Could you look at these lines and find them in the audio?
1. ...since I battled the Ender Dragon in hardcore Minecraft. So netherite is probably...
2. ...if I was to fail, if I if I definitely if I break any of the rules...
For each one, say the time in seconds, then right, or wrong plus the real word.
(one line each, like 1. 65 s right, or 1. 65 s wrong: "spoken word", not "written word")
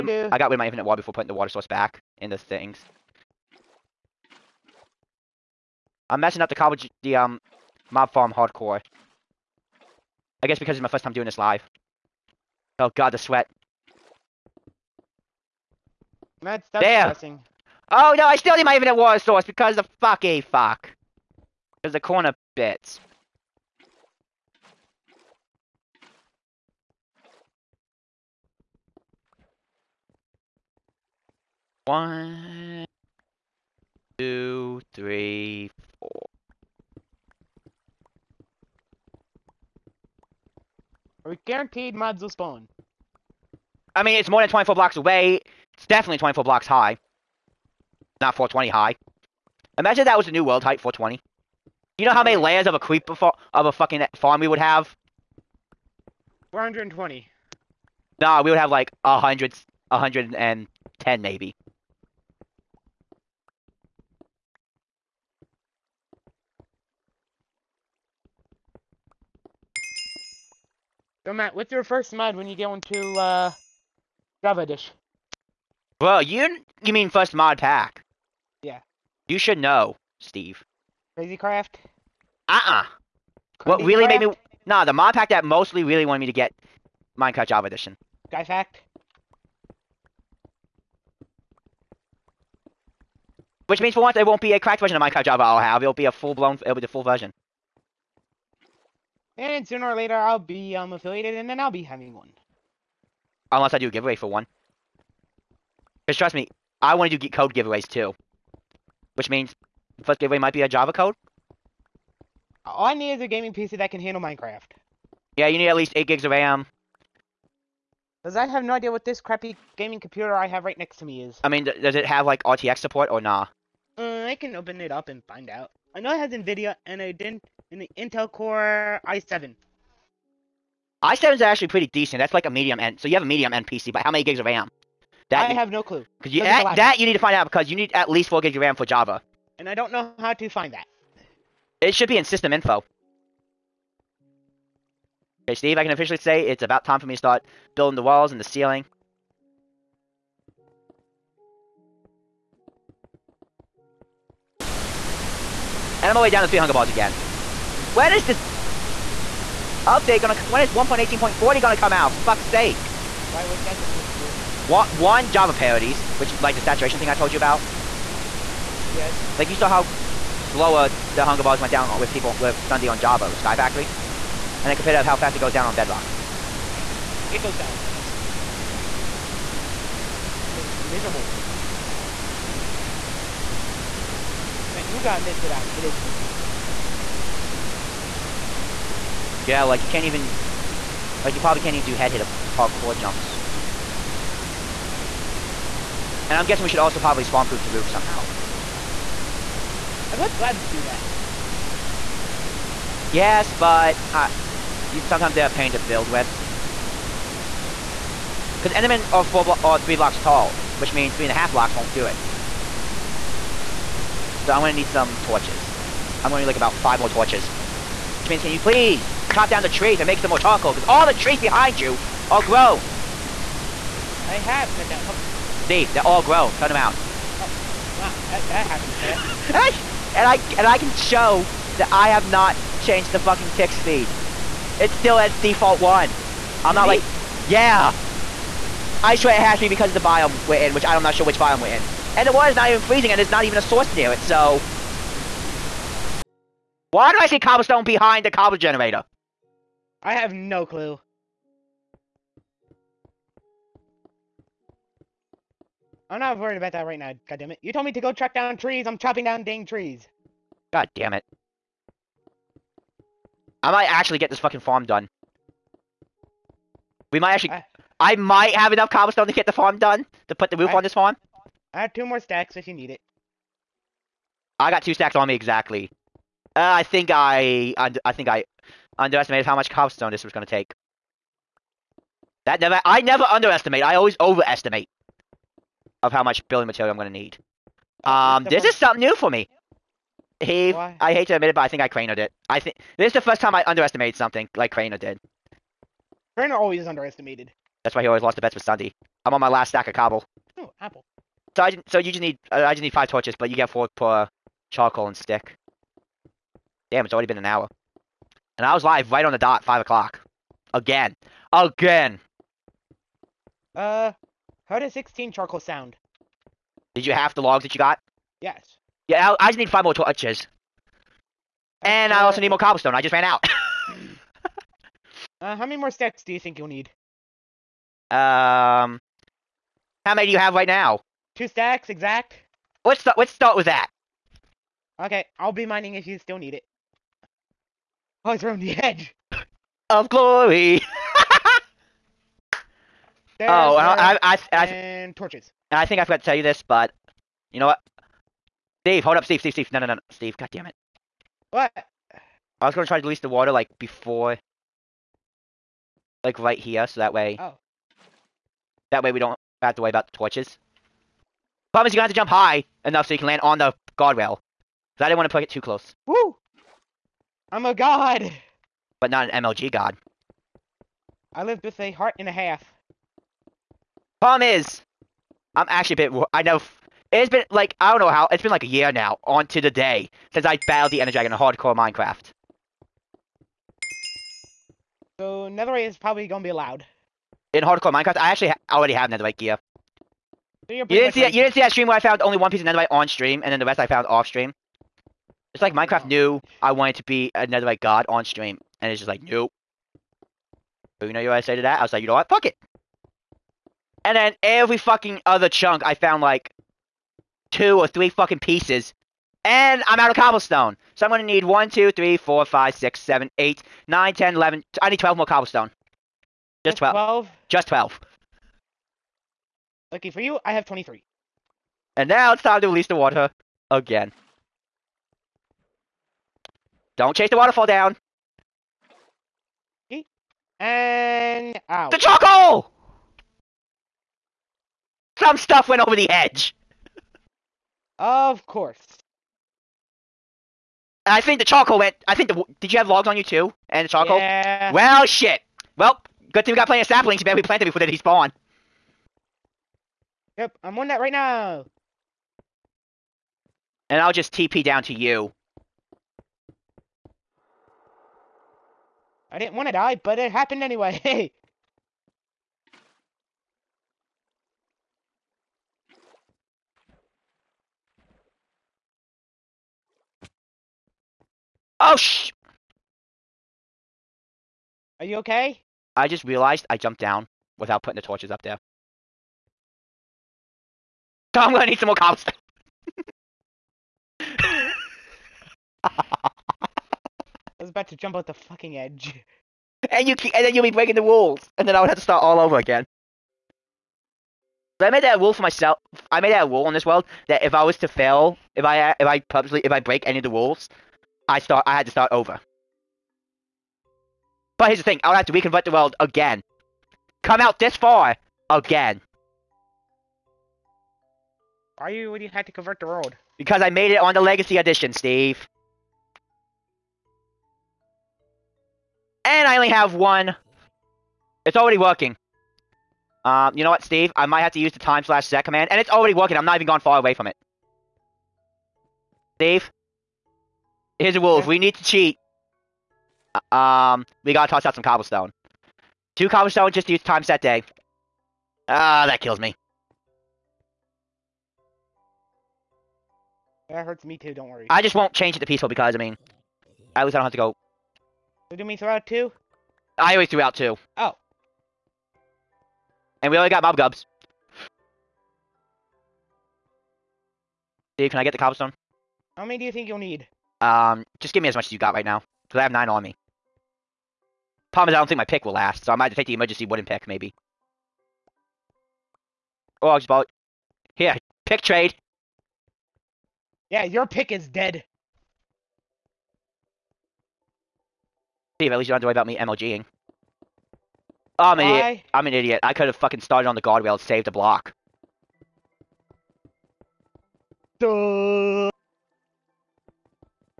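1. 380 s right
2. 497 s wrong: "purposely", not "definitely".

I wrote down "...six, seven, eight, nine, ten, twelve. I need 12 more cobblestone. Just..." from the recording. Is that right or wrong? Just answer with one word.
wrong.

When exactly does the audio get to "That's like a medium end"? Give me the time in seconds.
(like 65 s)
132 s.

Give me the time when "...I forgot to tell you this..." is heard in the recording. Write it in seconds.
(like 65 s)
345 s.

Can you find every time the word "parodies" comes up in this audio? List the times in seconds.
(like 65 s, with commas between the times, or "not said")
165 s.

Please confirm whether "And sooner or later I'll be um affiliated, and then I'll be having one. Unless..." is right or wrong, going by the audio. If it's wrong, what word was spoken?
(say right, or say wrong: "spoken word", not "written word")
right.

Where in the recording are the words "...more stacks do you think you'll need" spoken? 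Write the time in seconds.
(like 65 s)
325 s.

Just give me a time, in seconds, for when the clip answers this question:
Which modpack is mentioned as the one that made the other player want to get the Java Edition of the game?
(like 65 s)
81 s.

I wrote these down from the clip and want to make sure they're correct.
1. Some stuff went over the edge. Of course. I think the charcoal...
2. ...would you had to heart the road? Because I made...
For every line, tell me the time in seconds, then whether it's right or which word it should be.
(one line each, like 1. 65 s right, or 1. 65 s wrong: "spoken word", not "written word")
1. 435 s right
2. 512 s wrong: "convert", not "heart".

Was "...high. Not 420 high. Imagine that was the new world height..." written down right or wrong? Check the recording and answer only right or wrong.
right.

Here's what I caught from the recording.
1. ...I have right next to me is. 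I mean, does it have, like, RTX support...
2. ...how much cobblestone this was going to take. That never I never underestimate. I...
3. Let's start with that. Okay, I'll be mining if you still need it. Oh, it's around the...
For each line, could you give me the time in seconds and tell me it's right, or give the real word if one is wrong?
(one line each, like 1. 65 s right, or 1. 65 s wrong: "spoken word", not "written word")
1. 120 s right
2. 279 s right
3. 333 s right.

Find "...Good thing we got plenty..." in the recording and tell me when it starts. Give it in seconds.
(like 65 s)
446 s.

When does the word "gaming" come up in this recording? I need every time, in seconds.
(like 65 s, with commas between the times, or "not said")
113 s, 119 s.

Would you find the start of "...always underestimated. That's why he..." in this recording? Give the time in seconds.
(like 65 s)
296 s.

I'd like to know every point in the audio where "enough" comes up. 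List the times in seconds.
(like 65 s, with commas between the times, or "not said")
268 s, 362 s.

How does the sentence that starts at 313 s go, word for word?
Uh, how does sixteen charcoal sound?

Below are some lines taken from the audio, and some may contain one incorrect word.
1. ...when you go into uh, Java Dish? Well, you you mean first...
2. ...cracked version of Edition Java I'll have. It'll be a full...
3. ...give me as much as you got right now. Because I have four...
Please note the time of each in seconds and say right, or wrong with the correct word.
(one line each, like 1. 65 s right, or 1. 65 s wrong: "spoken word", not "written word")
1. 72 s right
2. 94 s wrong: "Minecraft", not "Edition"
3. 561 s wrong: "nine", not "four".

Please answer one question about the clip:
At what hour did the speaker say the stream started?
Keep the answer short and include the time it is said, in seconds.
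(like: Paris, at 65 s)
5 o'clock, at 309 s.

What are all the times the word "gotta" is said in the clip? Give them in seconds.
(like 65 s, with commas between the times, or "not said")
185 s, 534 s.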